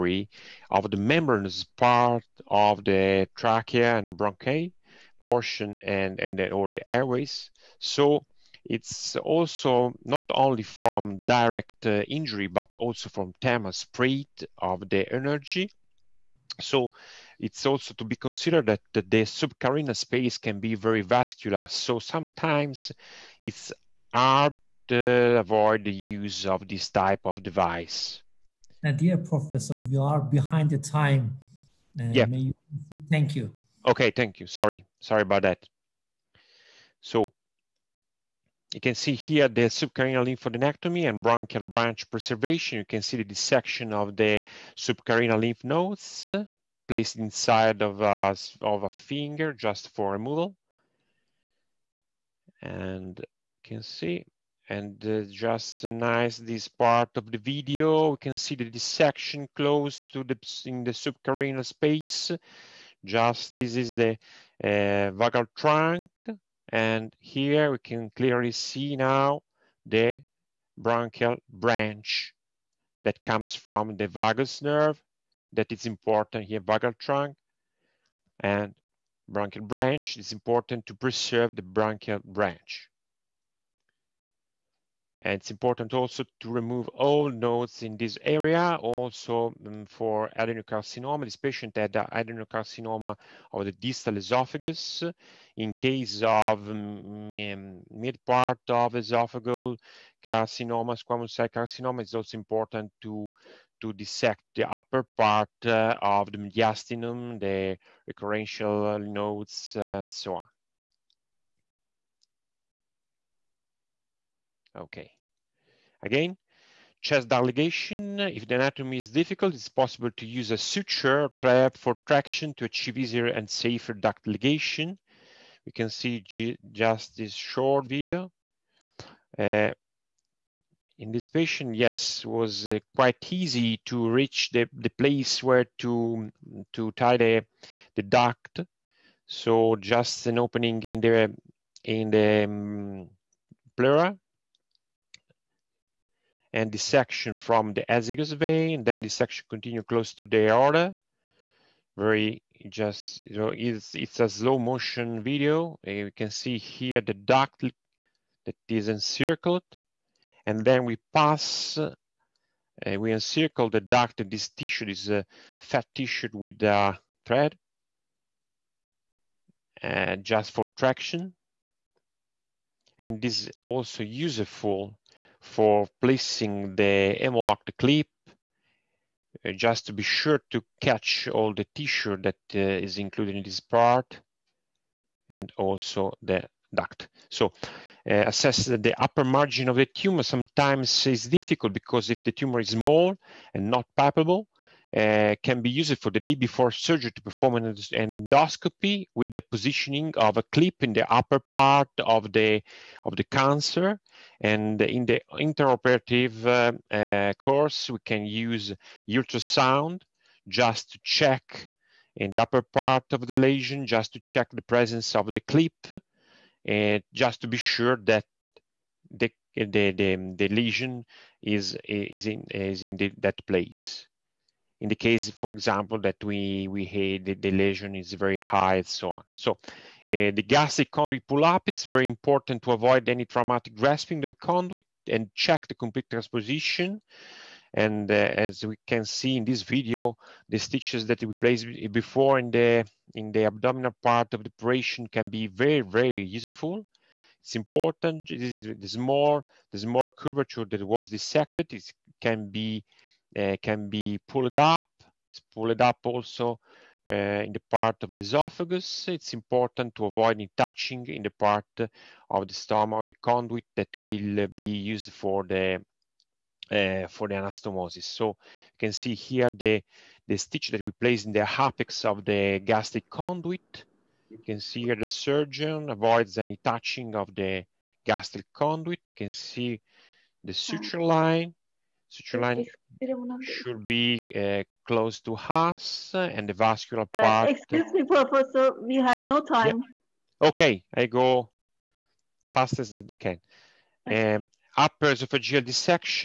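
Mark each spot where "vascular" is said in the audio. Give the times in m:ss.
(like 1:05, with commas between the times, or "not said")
0:21, 4:46.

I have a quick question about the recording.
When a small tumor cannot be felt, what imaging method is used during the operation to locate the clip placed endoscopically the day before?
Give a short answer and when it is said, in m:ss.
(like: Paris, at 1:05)
Ultrasound, at 3:29.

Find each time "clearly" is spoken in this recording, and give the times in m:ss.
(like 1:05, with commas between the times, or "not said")
1:08.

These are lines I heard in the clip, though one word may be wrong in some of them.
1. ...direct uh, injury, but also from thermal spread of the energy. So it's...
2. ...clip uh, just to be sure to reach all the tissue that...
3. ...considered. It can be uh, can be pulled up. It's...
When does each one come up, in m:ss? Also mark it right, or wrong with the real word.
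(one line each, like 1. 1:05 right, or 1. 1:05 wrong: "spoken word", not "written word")
1. 0:11 right
2. 2:57 wrong: "catch", not "reach"
3. 4:11 wrong: "dissected", not "considered".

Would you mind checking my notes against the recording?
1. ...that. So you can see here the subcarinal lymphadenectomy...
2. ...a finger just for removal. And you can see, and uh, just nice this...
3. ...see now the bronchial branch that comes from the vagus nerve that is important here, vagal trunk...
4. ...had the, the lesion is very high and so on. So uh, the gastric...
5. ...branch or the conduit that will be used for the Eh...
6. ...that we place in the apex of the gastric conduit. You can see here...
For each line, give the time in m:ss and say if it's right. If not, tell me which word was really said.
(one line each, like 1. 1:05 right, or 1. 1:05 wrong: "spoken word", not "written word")
1. 0:35 right
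2. 0:48 right
3. 1:08 right
4. 3:46 right
5. 4:22 wrong: "stomach", not "branch"
6. 4:30 right.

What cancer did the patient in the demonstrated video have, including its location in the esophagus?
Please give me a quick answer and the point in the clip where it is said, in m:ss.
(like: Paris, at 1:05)
Adenocarcinoma of the distal esophagus, at 1:31.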